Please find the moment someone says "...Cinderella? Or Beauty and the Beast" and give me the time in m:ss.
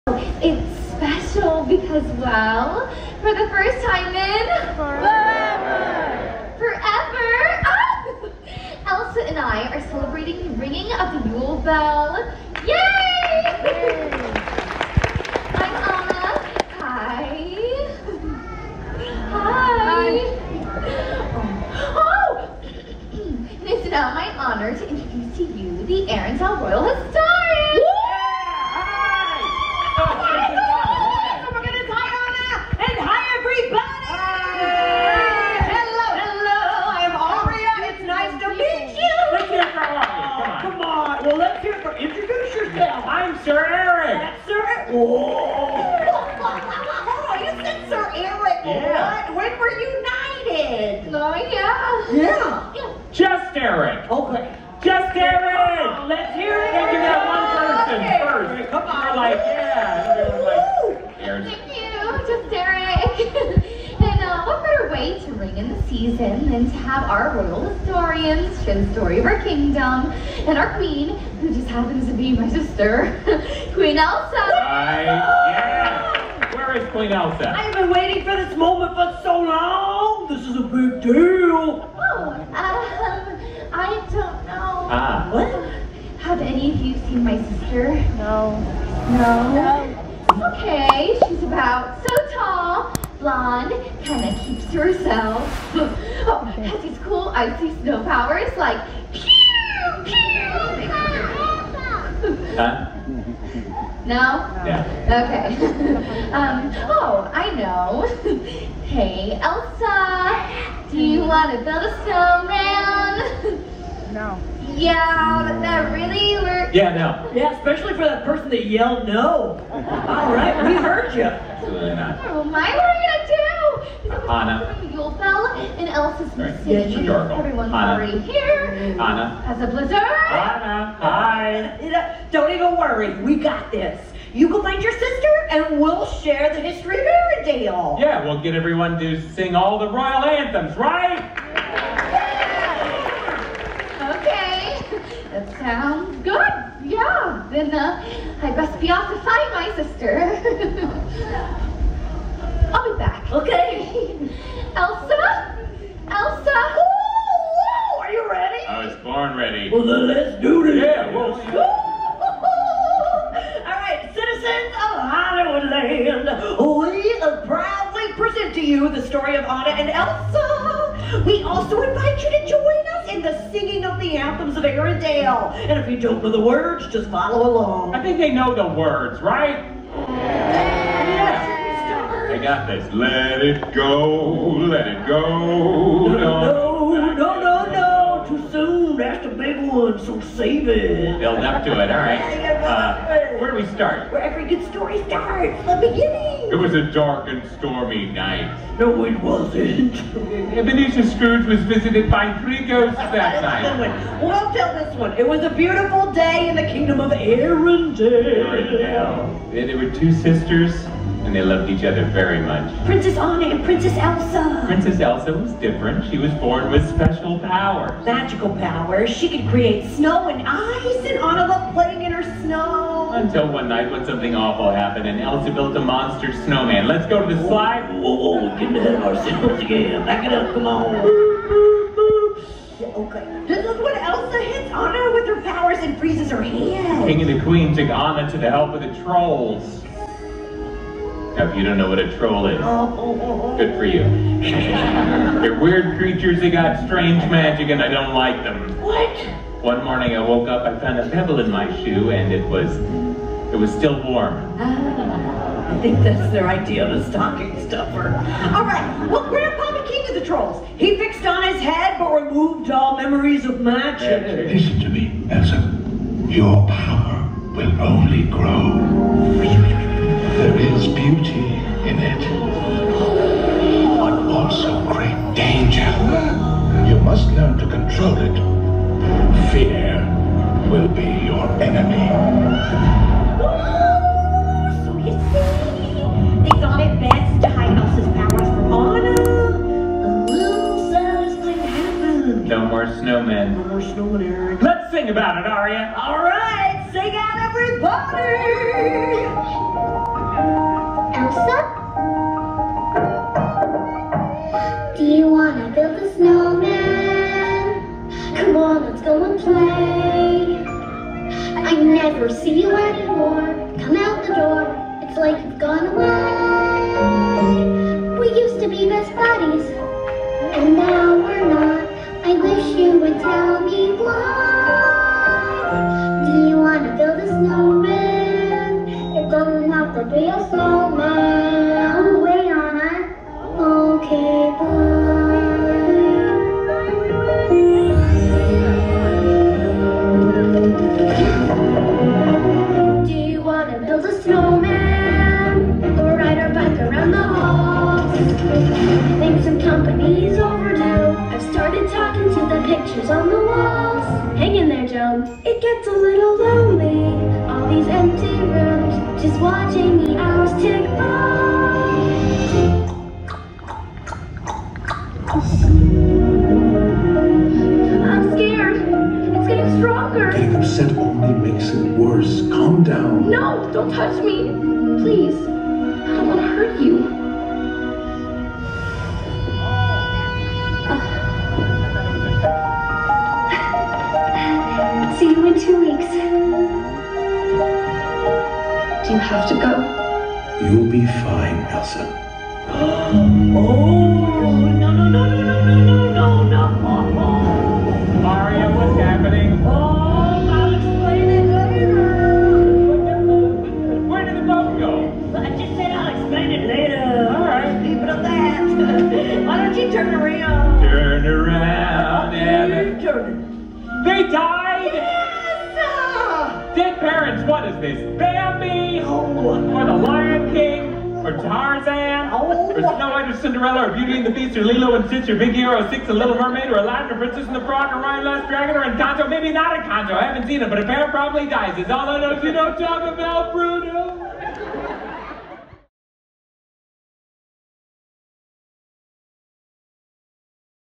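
7:03.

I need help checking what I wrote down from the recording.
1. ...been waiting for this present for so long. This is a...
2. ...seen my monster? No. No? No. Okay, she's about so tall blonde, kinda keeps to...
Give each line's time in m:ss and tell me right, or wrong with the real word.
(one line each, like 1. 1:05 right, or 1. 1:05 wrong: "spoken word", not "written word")
1. 1:17 wrong: "moment", not "present"
2. 1:26 wrong: "sister", not "monster".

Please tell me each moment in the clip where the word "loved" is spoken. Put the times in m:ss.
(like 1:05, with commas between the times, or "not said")
3:31, 3:41.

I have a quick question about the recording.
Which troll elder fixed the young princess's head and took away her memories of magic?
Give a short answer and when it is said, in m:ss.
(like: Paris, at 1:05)
Grandpa McKee, at 4:19.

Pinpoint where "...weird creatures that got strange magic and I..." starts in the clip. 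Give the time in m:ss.
4:05.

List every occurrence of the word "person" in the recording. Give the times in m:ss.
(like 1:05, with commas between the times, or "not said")
0:57, 1:58.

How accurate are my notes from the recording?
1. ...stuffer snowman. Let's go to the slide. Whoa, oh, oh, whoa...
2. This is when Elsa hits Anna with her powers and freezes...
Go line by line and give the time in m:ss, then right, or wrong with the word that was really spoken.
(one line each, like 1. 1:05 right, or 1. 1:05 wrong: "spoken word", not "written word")
1. 3:45 wrong: "monster", not "stuffer"
2. 3:53 right.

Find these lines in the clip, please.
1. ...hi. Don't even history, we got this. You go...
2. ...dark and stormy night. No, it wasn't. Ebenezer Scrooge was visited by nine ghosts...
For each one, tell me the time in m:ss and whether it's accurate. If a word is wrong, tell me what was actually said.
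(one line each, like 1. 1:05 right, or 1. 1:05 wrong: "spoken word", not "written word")
1. 2:11 wrong: "worry", not "history"
2. 3:16 wrong: "three", not "nine".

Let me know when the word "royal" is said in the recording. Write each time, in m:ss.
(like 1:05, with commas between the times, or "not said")
1:07, 2:19.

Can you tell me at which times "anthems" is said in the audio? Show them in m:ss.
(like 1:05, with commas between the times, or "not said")
2:20, 2:54.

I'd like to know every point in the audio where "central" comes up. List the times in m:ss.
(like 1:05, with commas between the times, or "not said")
not said.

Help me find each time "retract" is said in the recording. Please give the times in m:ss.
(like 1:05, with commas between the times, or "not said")
not said.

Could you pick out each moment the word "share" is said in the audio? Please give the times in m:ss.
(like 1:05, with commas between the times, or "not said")
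1:08, 2:16.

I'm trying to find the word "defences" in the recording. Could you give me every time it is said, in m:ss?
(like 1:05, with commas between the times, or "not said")
not said.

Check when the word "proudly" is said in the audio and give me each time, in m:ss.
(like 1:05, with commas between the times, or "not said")
2:47.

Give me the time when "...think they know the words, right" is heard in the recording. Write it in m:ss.
2:58.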